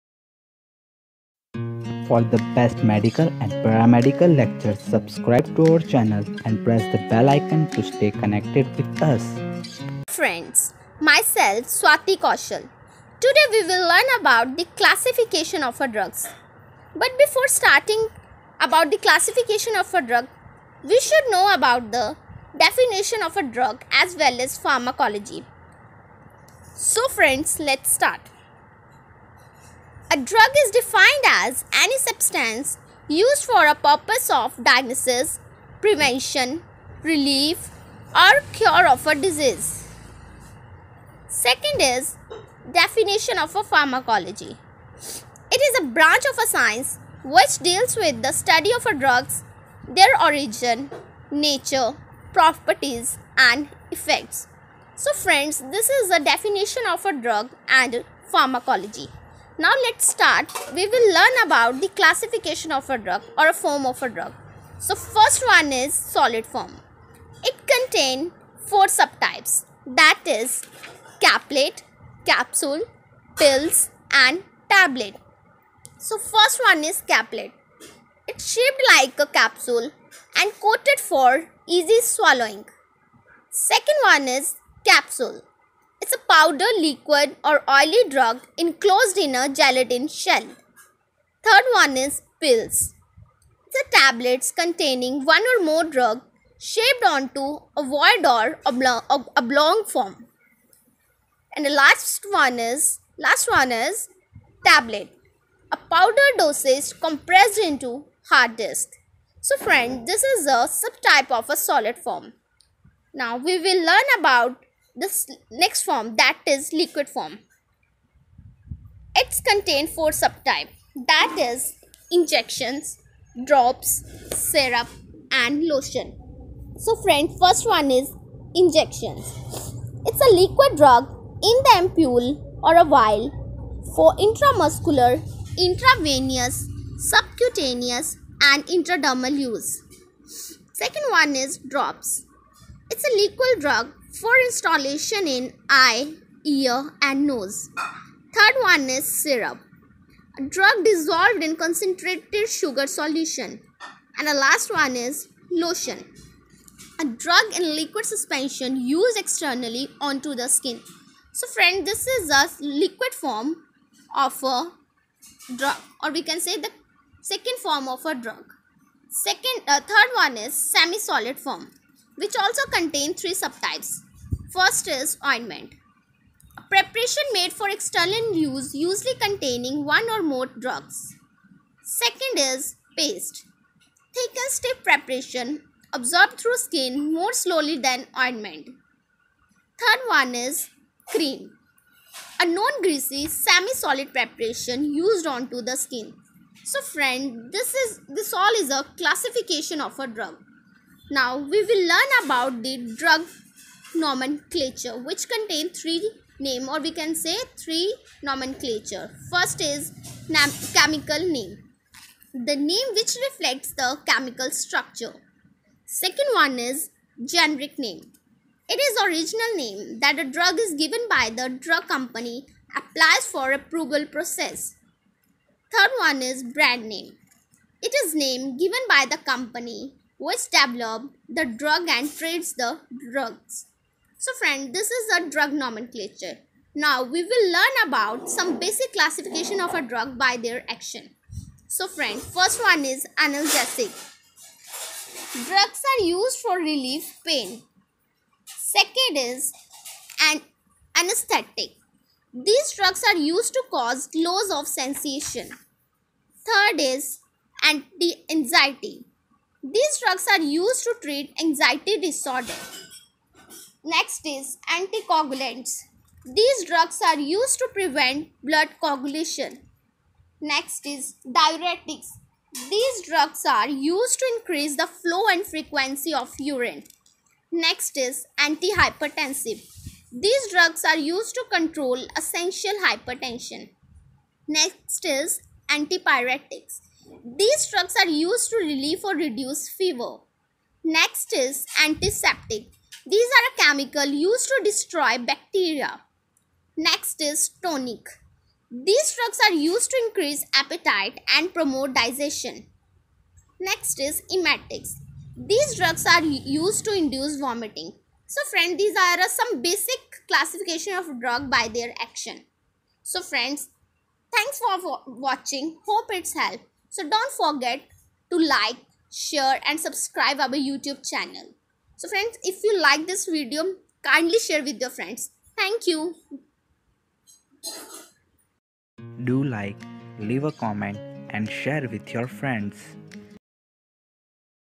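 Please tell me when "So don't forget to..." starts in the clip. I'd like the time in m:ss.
5:16.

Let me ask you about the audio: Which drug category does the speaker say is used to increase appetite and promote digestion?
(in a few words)
Tonic.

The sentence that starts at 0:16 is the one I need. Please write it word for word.
But before starting about the classification of a drug, we should know about the definition of a drug as well as pharmacology.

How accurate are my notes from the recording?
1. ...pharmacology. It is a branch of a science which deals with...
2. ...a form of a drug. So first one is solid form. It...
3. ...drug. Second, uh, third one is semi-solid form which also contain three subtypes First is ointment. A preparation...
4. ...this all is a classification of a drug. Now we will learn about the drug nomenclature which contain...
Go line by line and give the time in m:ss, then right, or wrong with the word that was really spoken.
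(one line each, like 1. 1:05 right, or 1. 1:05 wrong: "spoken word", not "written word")
1. 0:43 right
2. 1:03 right
3. 2:48 right
4. 3:18 right.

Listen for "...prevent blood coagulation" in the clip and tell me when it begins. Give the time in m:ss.
4:27.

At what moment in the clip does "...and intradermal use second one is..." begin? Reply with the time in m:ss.
2:18.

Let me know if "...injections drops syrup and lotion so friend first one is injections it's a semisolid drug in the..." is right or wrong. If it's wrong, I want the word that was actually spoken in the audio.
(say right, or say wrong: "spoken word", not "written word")
wrong: "liquid", not "semisolid".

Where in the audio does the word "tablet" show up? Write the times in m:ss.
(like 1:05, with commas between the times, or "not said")
1:14, 1:33, 1:44.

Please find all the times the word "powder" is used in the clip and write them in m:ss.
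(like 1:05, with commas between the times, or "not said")
1:26, 1:45.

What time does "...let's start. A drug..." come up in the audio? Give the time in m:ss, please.
0:27.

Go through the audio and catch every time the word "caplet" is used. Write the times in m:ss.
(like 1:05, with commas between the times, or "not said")
1:11, 1:17.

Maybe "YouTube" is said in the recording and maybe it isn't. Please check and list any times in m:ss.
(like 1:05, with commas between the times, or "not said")
5:20.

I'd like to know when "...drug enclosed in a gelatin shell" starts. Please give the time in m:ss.
1:28.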